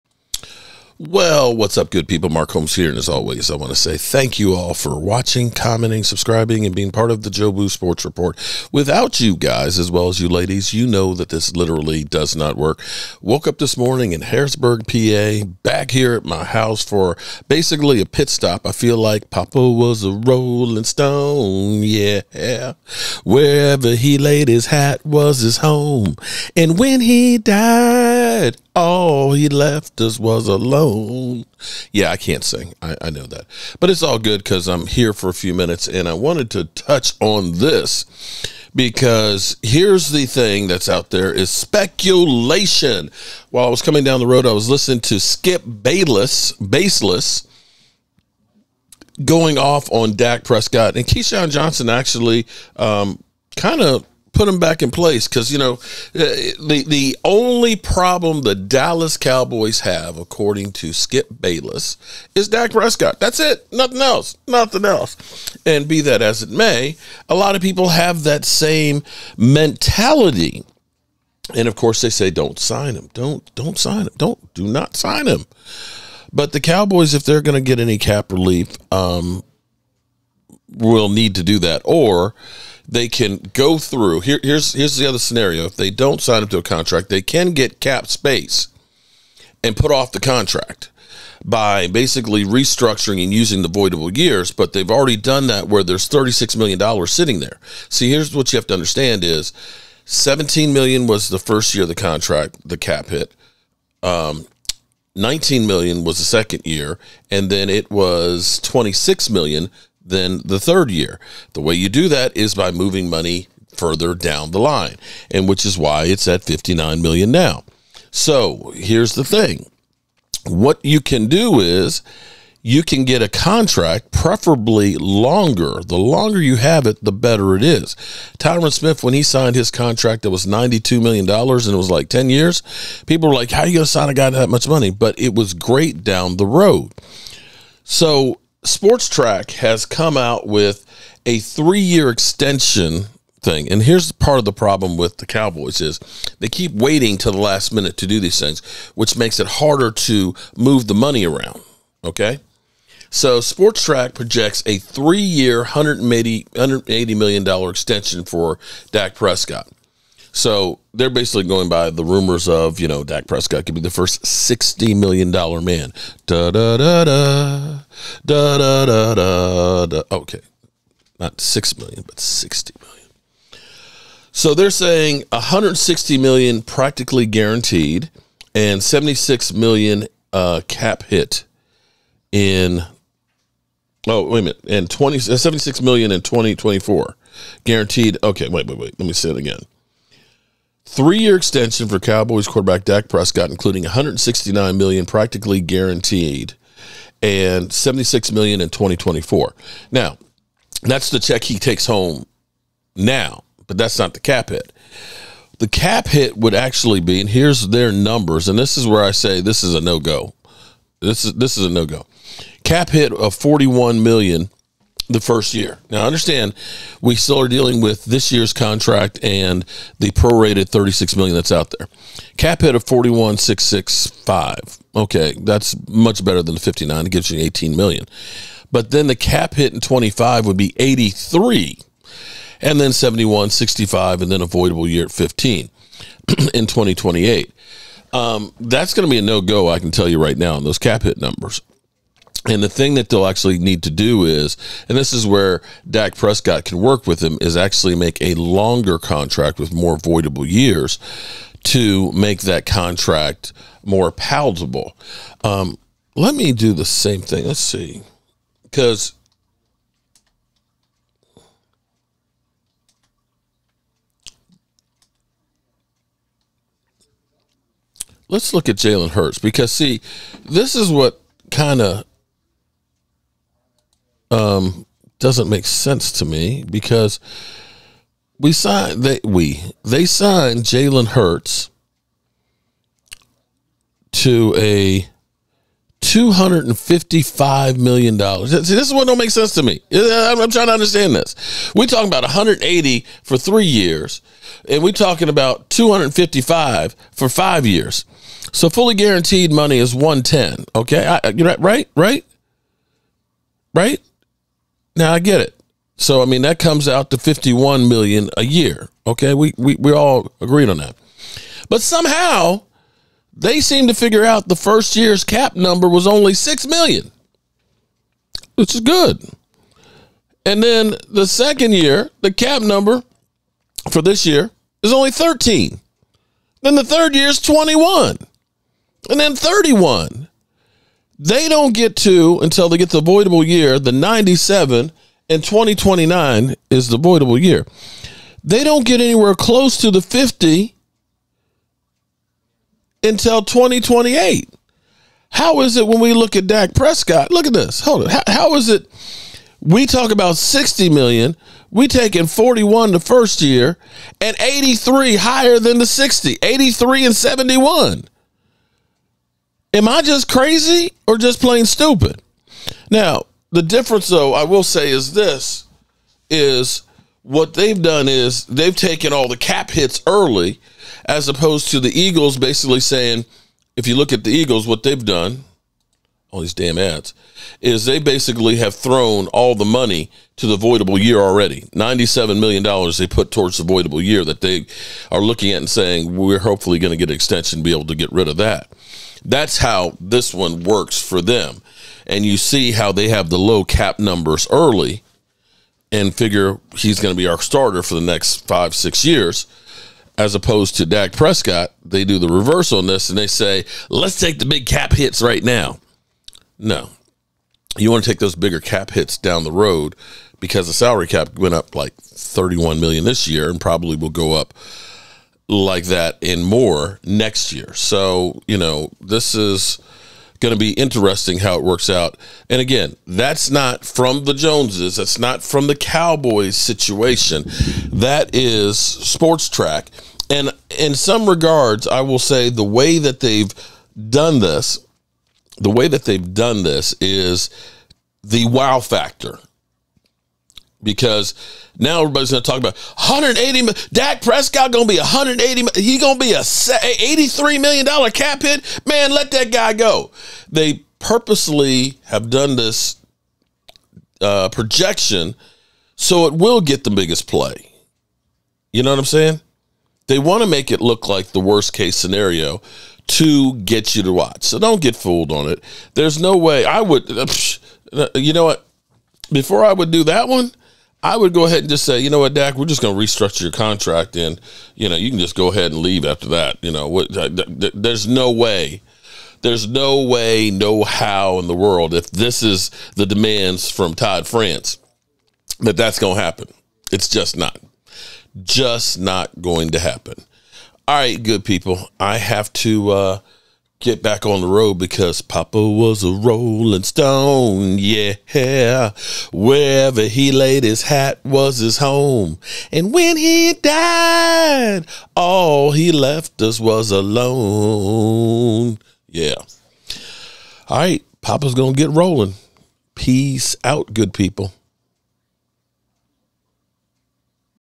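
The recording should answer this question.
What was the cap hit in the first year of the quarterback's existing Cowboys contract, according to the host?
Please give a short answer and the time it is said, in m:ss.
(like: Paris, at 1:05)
17 million, at 1:40.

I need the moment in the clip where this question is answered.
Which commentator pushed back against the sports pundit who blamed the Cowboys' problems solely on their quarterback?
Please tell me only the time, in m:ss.
0:51.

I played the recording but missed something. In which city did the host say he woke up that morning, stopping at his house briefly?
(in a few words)
Harrisburg, PA.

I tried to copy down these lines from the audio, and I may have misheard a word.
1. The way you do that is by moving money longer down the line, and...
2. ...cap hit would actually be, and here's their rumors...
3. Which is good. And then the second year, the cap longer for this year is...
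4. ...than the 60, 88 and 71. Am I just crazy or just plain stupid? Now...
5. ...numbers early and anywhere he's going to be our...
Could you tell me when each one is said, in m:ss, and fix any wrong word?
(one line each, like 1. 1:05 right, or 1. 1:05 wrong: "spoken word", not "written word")
1. 1:51 wrong: "further", not "longer"
2. 3:25 wrong: "numbers", not "rumors"
3. 5:18 wrong: "number", not "longer"
4. 5:55 wrong: "83", not "88"
5. 6:33 wrong: "figure", not "anywhere".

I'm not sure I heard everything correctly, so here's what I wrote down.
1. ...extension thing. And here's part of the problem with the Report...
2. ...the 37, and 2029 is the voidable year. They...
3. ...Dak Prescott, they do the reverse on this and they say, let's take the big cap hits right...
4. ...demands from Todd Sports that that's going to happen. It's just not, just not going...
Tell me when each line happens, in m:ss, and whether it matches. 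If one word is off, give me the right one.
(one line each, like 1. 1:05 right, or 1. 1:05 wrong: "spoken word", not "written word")
1. 2:22 wrong: "Cowboys", not "Report"
2. 5:33 wrong: "97", not "37"
3. 6:40 right
4. 8:03 wrong: "France", not "Sports".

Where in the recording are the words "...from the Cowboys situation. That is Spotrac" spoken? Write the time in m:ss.
7:05.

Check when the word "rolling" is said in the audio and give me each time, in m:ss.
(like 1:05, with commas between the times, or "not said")
0:20, 8:16, 8:31.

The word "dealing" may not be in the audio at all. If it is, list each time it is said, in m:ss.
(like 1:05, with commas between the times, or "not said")
3:37.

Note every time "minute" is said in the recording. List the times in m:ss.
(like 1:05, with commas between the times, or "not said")
0:35, 2:27, 3:04.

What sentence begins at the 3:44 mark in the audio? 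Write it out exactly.
Okay, that's much better than the 59.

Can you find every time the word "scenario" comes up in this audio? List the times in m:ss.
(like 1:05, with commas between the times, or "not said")
1:25, 7:41.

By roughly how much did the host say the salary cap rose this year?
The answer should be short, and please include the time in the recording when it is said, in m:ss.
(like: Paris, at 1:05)
31 million, at 6:51.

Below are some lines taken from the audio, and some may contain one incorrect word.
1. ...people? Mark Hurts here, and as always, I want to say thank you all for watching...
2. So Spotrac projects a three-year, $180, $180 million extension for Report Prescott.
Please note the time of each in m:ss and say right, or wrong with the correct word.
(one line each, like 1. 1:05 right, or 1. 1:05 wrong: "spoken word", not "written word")
1. 0:02 wrong: "Holmes", not "Hurts"
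2. 2:33 wrong: "Dak", not "Report".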